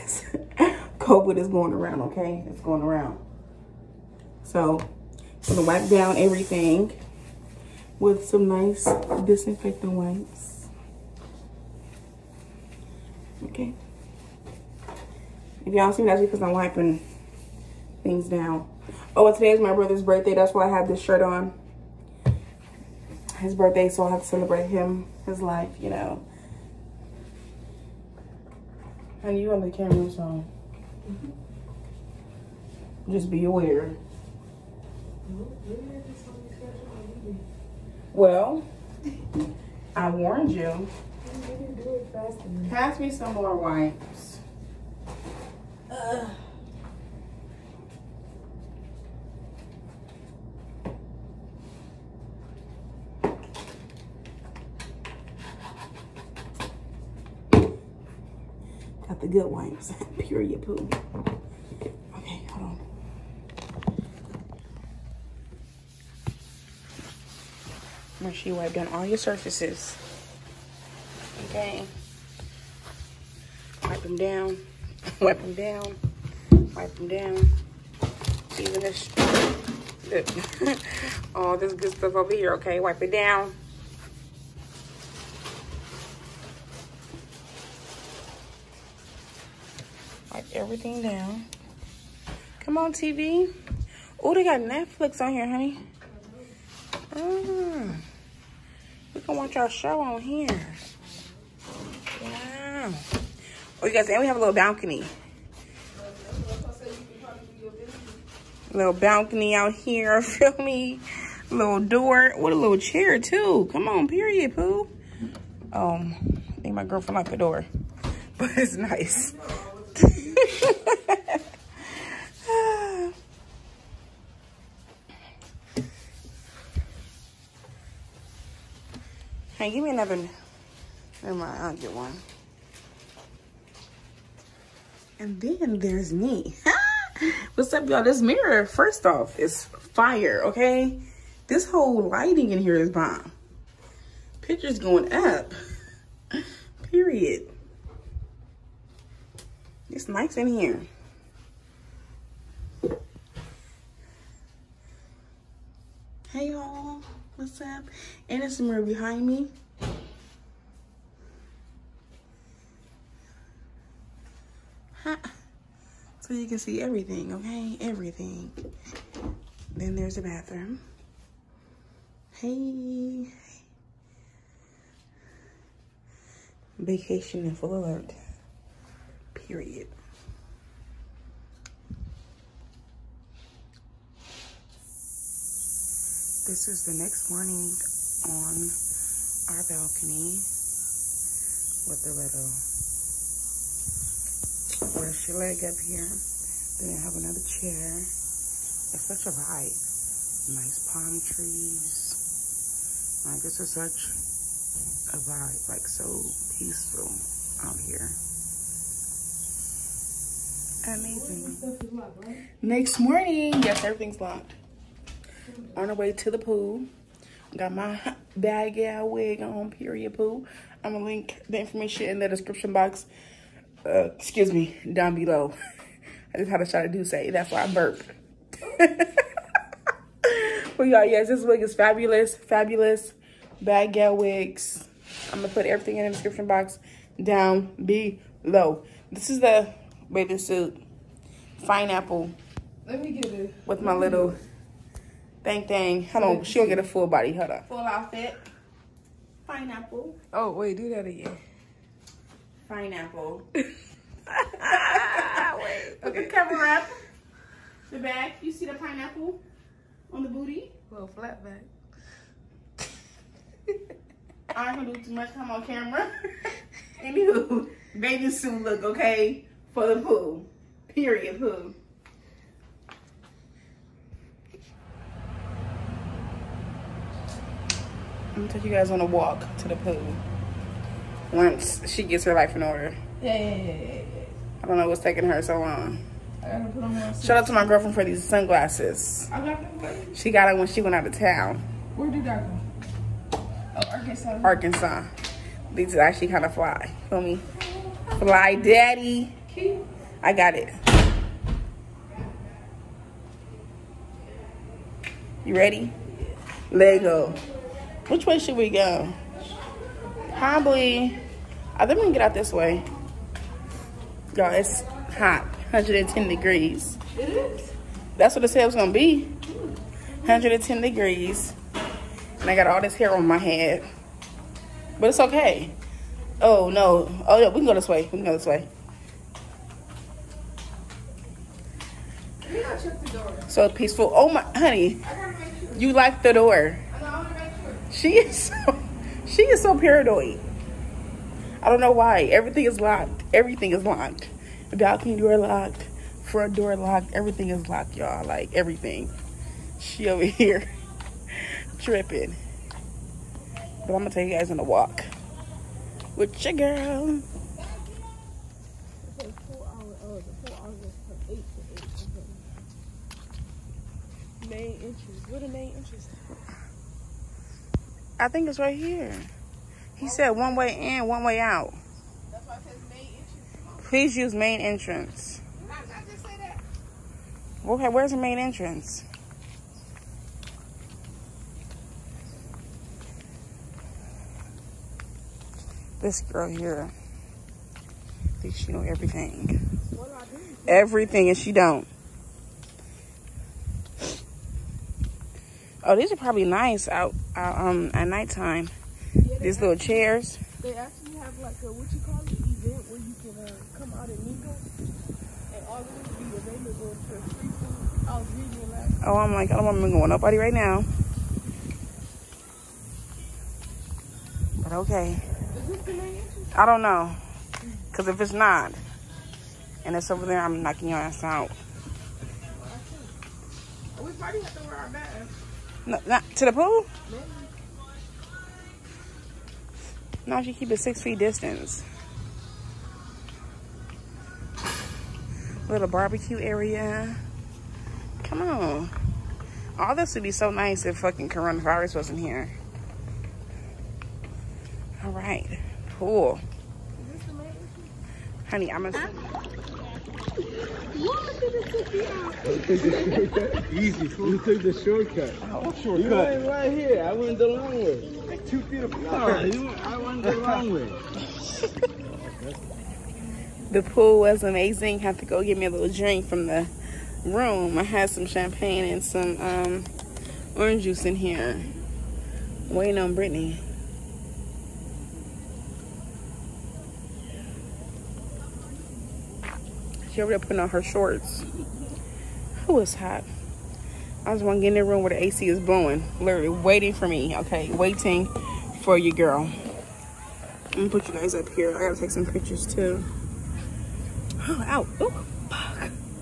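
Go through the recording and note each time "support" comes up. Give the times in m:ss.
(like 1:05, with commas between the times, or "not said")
not said.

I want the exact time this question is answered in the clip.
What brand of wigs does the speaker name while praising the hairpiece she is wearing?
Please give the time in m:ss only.
3:53.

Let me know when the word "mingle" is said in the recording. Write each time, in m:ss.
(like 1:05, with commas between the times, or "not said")
6:44, 6:49.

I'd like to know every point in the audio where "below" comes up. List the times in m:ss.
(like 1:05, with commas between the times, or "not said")
3:45, 3:57.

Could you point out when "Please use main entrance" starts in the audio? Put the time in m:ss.
6:13.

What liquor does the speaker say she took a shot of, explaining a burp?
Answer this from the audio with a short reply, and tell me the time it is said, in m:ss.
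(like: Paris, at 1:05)
D'USSÉ, at 3:46.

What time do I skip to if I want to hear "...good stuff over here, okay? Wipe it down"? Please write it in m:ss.
1:21.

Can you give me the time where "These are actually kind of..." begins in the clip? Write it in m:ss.
4:55.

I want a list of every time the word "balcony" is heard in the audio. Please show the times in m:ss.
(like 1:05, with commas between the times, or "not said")
1:44, 1:48, 3:09, 5:44.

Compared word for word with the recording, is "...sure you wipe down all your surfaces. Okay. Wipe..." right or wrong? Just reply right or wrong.
right.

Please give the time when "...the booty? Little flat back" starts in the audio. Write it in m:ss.
4:20.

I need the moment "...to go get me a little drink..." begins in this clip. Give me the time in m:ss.
7:45.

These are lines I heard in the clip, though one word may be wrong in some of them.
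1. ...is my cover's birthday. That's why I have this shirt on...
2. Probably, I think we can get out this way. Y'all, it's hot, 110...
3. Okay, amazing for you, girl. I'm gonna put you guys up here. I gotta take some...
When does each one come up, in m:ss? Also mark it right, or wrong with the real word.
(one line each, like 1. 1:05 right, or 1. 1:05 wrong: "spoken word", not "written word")
1. 0:19 wrong: "brother", not "cover"
2. 5:10 right
3. 8:07 wrong: "waiting", not "amazing".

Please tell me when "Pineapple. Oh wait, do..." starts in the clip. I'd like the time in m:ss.
4:09.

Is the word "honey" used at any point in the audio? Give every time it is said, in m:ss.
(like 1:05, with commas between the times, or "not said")
1:35, 5:34, 7:28.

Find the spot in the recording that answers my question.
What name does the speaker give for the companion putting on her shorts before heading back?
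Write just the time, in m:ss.
7:53.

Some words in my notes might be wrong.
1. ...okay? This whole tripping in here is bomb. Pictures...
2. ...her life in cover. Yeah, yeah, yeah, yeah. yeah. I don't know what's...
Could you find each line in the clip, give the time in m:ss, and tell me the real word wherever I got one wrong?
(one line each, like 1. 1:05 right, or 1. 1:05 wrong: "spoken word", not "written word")
1. 2:20 wrong: "lighting", not "tripping"
2. 4:42 wrong: "order", not "cover".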